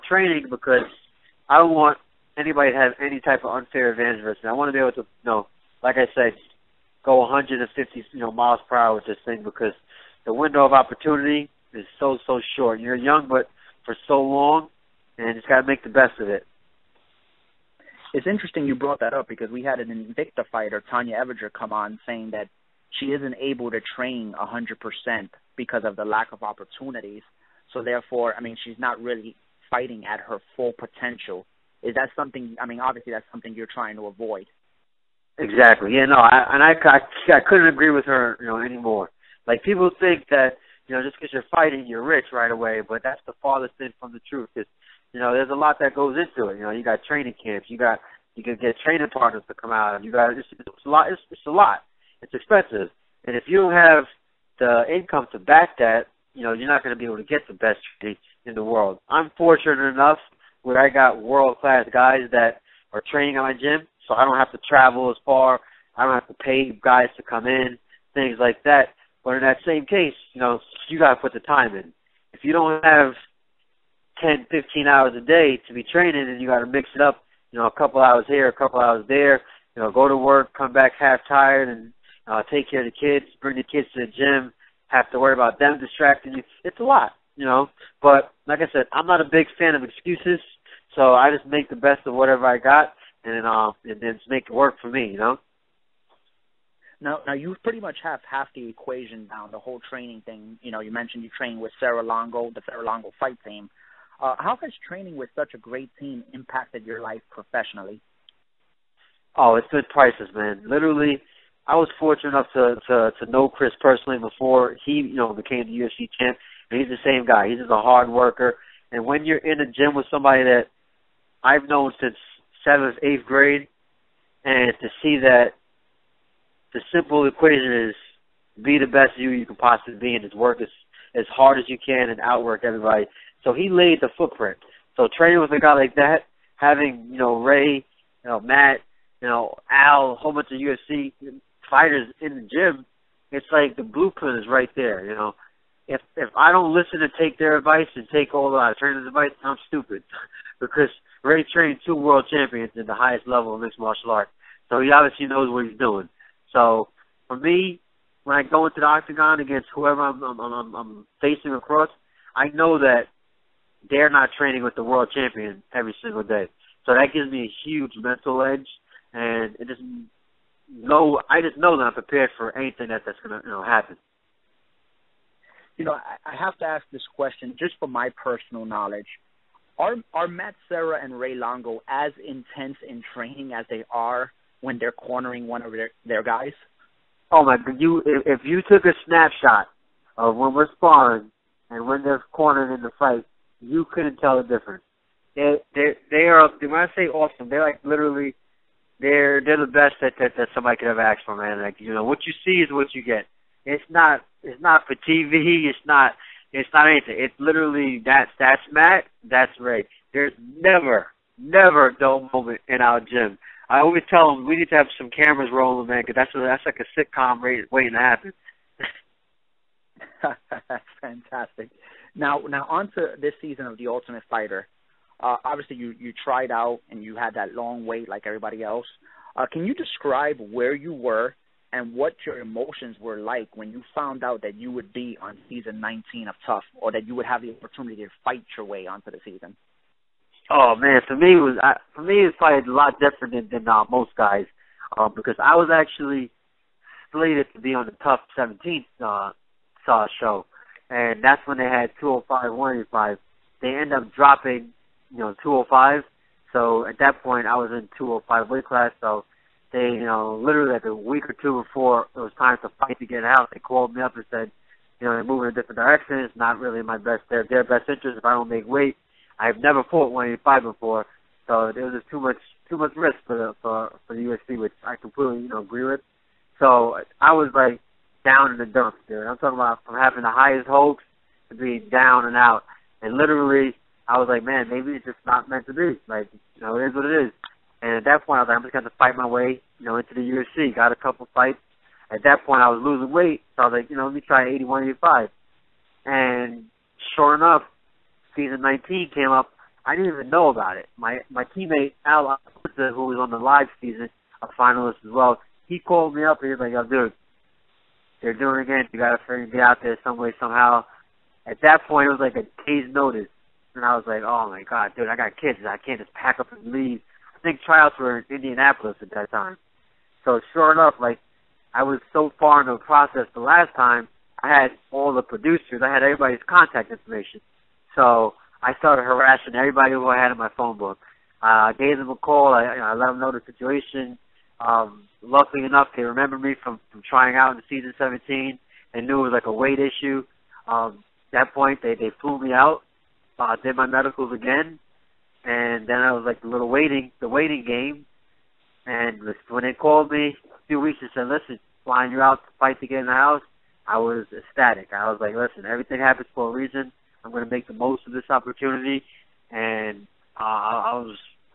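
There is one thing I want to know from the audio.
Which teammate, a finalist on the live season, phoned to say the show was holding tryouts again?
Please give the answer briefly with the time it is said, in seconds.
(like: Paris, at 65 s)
Al Iaquinta, at 302 s.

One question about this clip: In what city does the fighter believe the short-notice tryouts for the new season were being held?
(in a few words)
Indianapolis.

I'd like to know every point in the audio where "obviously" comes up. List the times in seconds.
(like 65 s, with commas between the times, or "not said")
32 s, 154 s, 225 s.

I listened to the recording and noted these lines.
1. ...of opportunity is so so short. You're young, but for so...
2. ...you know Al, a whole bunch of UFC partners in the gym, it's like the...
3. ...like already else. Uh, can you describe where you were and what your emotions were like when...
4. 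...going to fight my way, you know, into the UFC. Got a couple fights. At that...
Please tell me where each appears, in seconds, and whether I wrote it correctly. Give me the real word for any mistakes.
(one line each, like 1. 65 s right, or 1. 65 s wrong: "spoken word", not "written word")
1. 10 s right
2. 139 s wrong: "fighters", not "partners"
3. 228 s wrong: "everybody", not "already"
4. 288 s right.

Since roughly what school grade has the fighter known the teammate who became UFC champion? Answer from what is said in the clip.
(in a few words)
seventh, eighth grade.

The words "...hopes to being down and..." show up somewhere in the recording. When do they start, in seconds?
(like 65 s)
280 s.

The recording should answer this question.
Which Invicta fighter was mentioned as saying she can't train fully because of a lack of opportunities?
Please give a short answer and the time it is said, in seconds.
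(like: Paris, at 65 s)
Tonya Evinger, at 20 s.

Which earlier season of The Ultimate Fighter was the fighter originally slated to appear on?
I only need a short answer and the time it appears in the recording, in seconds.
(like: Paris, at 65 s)
TUF 17, at 248 s.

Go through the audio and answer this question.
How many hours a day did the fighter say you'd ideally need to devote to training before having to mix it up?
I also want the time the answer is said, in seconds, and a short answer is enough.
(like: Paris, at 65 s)
10, 15 hours, at 74 s.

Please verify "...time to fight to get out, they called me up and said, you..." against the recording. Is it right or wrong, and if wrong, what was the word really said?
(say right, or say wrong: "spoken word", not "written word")
right.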